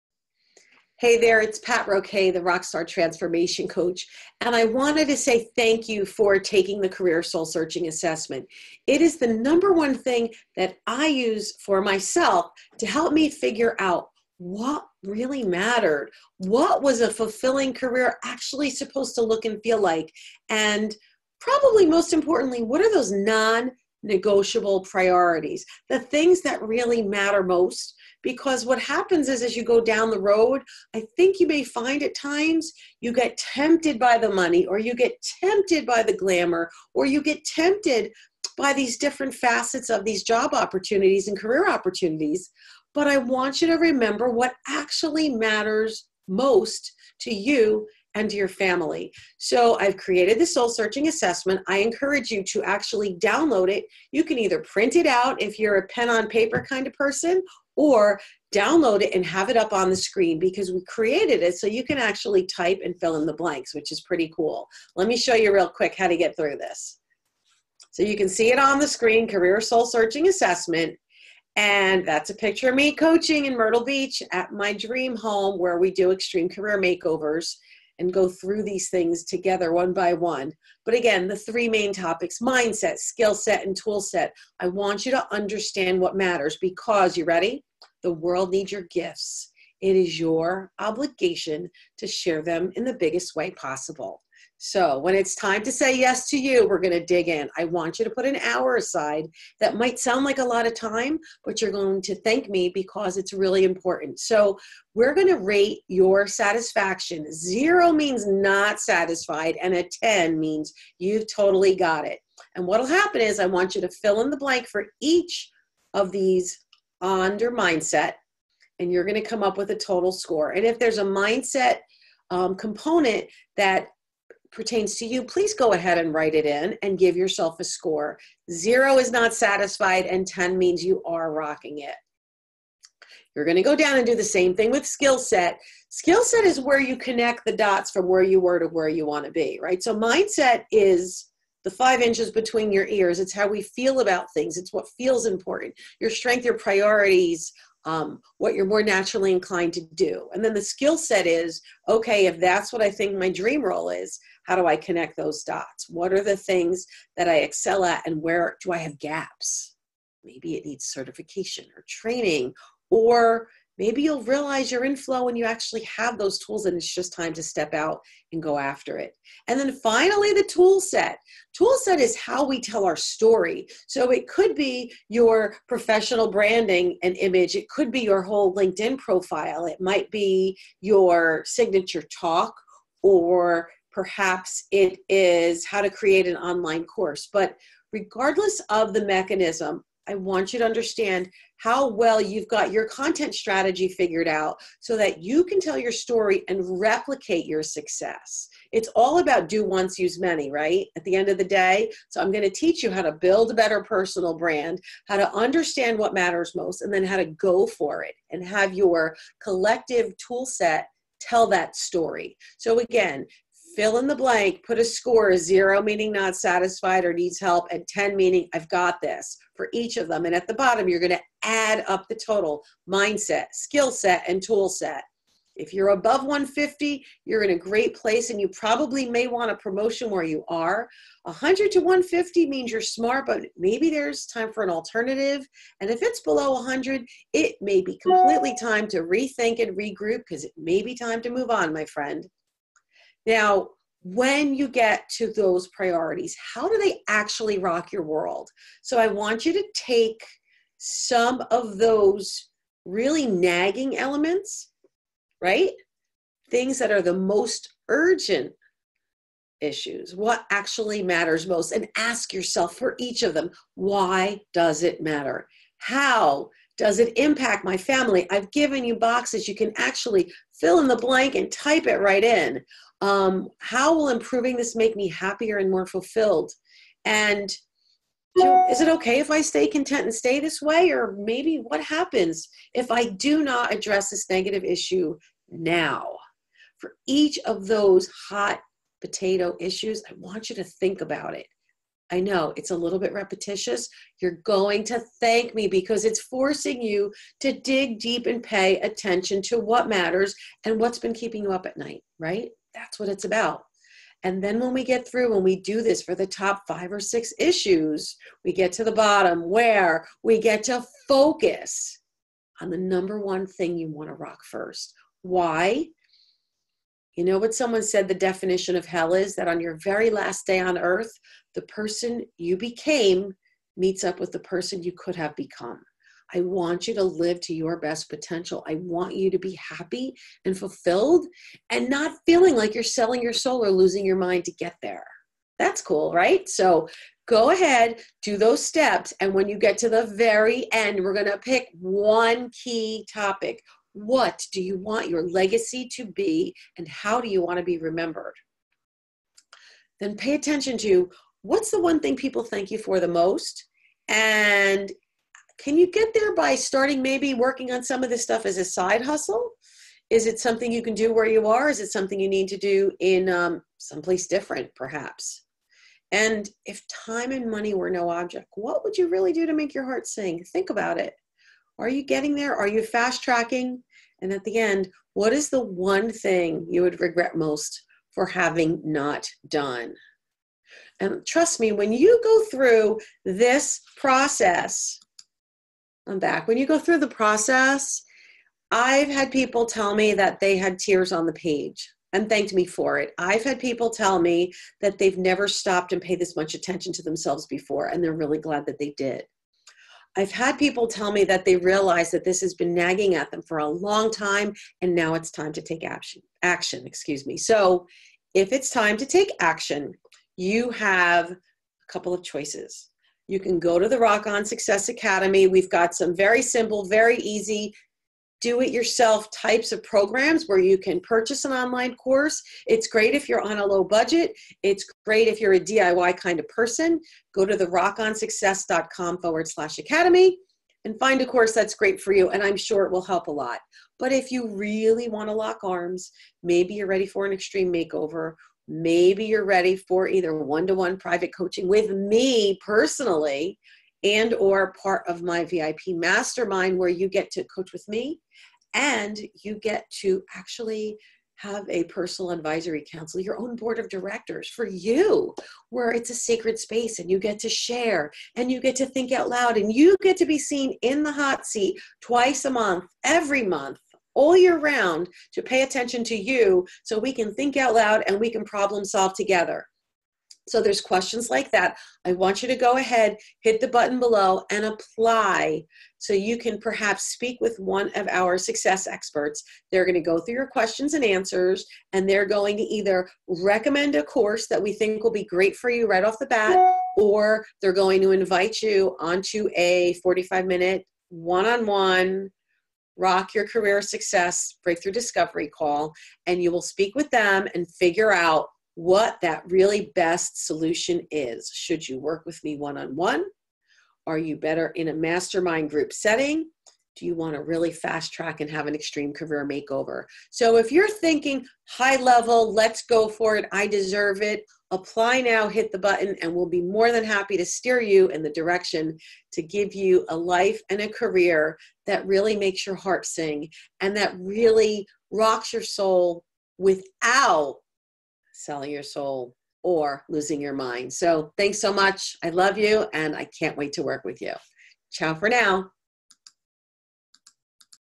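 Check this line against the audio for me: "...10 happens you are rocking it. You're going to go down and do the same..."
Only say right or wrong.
wrong.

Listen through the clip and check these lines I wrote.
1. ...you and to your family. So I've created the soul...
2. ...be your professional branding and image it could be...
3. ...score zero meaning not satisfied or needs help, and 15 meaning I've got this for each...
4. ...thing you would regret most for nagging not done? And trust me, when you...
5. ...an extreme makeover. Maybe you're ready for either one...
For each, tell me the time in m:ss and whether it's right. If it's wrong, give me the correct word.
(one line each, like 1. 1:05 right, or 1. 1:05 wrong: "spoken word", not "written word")
1. 0:47 right
2. 2:54 right
3. 3:34 wrong: "10", not "15"
4. 6:16 wrong: "having", not "nagging"
5. 7:17 right.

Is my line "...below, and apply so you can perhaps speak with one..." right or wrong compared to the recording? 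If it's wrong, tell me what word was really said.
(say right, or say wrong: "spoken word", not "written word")
right.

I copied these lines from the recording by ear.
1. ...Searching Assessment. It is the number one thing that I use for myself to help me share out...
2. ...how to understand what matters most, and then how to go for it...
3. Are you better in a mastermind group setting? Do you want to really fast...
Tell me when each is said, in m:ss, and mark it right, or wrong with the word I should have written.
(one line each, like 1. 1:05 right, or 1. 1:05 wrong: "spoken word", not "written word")
1. 0:07 wrong: "figure", not "share"
2. 3:25 right
3. 8:24 right.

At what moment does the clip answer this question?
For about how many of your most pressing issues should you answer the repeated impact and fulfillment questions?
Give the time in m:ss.
5:06.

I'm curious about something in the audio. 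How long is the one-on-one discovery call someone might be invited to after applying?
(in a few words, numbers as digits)
45 minutes.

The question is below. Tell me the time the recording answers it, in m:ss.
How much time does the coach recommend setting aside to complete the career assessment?
1:38.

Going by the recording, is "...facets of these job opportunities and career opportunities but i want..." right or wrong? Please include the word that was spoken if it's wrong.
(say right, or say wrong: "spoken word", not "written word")
right.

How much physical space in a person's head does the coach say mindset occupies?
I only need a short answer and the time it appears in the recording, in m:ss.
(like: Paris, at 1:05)
5 inches, at 2:21.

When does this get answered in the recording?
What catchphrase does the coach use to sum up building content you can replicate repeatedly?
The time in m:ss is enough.
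3:19.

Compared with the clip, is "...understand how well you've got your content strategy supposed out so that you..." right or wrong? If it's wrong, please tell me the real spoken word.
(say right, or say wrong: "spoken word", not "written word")
wrong: "figured", not "supposed".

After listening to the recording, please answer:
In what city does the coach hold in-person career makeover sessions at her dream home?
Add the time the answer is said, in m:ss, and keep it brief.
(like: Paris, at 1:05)
Myrtle Beach, at 1:13.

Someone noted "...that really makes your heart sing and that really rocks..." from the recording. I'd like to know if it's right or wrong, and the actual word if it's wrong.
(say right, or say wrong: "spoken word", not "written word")
right.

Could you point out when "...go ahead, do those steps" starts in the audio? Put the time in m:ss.
5:37.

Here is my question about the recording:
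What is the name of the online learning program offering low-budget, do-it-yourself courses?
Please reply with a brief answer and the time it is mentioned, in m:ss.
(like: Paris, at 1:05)
Rock On Success Academy, at 6:53.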